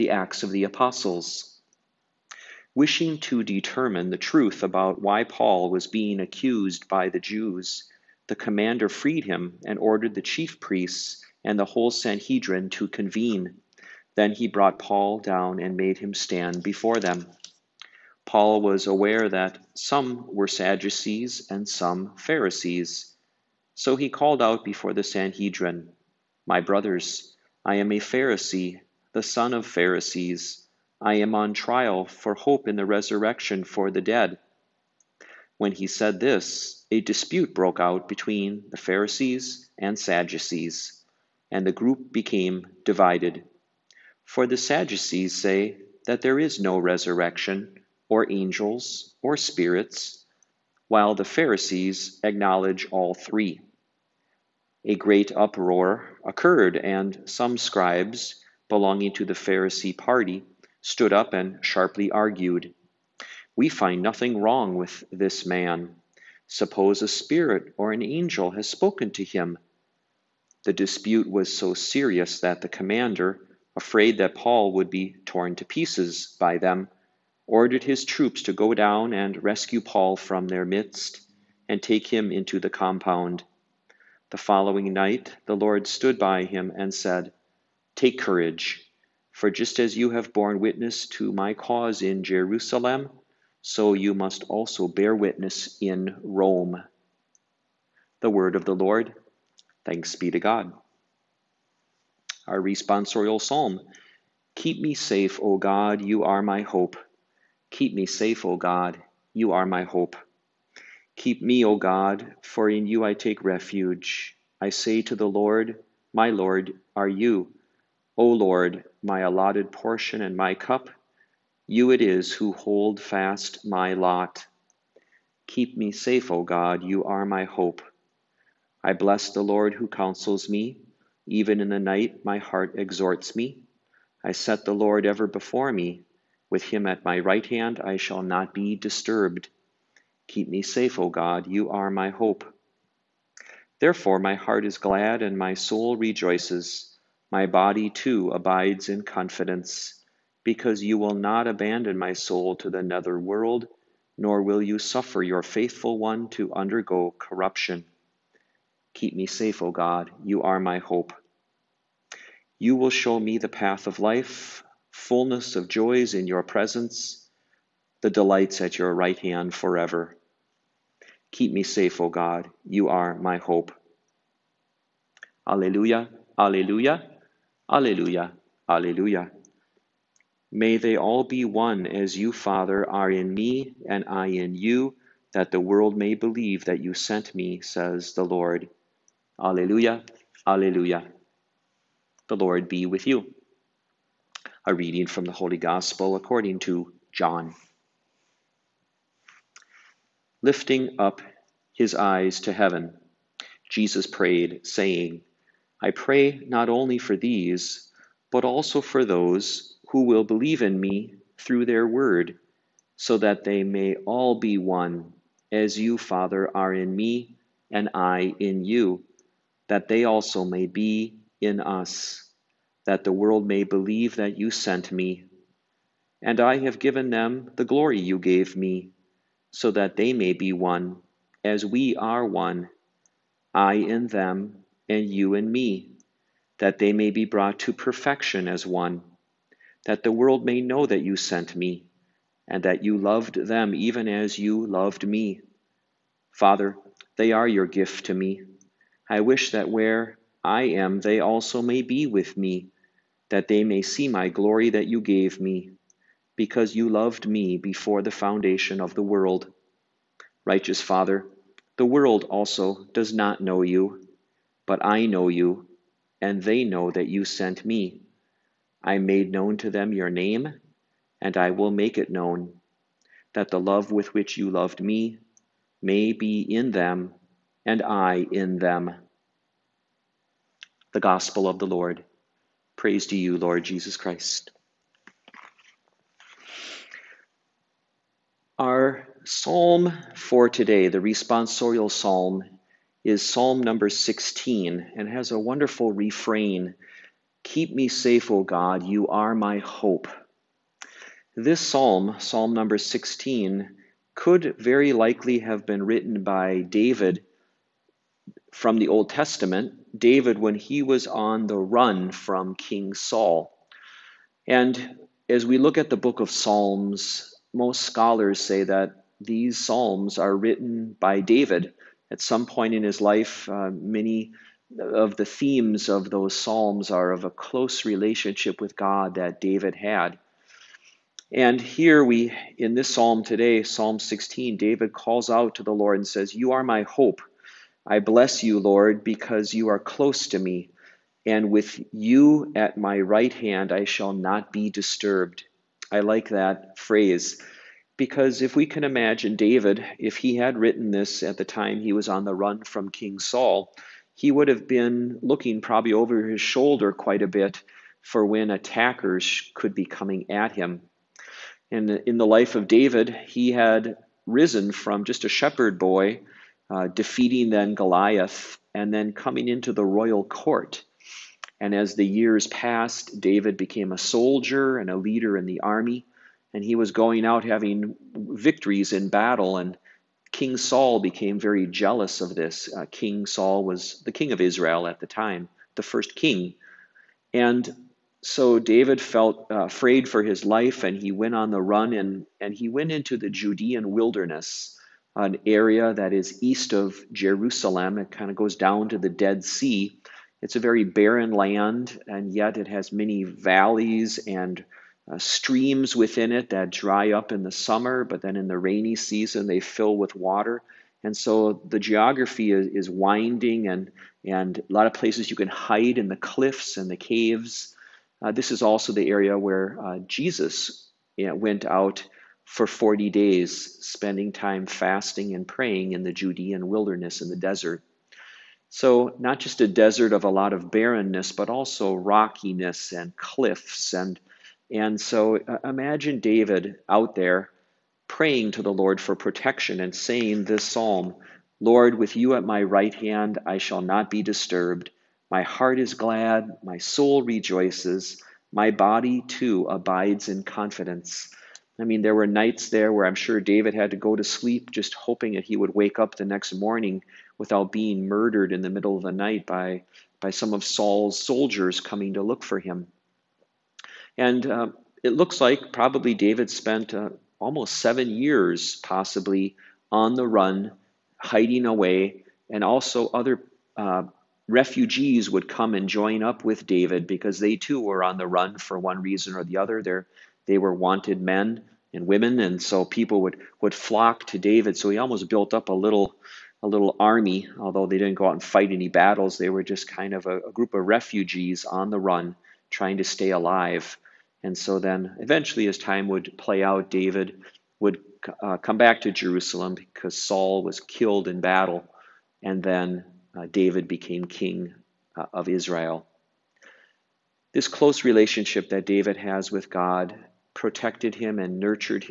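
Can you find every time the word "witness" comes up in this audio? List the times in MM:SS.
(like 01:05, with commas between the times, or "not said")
01:30, 01:35.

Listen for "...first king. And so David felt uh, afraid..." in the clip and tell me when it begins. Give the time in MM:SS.
06:25.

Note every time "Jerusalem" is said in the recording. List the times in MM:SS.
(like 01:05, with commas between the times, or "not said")
01:32, 06:37, 08:19.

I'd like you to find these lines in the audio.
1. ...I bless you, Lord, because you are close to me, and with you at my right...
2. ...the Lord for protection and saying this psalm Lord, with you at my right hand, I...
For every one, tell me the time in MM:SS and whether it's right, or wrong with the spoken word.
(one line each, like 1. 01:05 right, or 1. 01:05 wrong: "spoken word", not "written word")
1. 05:37 right
2. 07:18 right.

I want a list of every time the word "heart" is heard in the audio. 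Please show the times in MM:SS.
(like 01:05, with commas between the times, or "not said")
02:12, 02:24, 07:25.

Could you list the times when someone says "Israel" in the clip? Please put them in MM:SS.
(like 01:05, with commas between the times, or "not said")
06:24, 08:25.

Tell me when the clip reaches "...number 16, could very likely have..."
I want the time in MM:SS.
05:02.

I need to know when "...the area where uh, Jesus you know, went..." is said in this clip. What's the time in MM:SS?
06:58.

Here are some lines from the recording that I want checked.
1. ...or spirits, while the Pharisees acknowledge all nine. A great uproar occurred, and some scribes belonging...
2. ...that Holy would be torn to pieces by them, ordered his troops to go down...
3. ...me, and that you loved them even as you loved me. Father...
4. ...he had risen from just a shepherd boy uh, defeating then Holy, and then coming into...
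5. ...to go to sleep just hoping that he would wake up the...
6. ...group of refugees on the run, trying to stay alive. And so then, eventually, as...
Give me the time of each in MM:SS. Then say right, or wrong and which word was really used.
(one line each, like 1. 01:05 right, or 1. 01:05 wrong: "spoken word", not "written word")
1. 00:49 wrong: "three", not "nine"
2. 01:14 wrong: "Paul", not "Holy"
3. 04:01 right
4. 06:03 wrong: "Goliath", not "Holy"
5. 07:33 right
6. 08:10 right.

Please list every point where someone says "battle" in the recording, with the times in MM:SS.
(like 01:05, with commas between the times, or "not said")
06:19, 08:08, 08:21.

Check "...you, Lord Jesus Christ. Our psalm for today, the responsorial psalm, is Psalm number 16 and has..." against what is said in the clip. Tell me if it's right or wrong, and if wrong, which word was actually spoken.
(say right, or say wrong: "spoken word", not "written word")
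right.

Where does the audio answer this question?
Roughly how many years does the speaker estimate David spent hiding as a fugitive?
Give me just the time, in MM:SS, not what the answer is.
07:47.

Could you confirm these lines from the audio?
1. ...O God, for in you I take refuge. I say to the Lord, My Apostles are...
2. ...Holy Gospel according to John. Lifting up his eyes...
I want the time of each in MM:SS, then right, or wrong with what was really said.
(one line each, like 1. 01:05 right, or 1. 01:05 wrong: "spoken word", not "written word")
1. 01:51 wrong: "Lord", not "Apostles"
2. 03:15 right.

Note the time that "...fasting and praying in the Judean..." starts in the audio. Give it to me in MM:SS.
07:04.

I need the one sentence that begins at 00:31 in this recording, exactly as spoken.
I am on trial for hope in the resurrection for the dead.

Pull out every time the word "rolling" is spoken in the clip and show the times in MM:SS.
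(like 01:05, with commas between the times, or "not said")
not said.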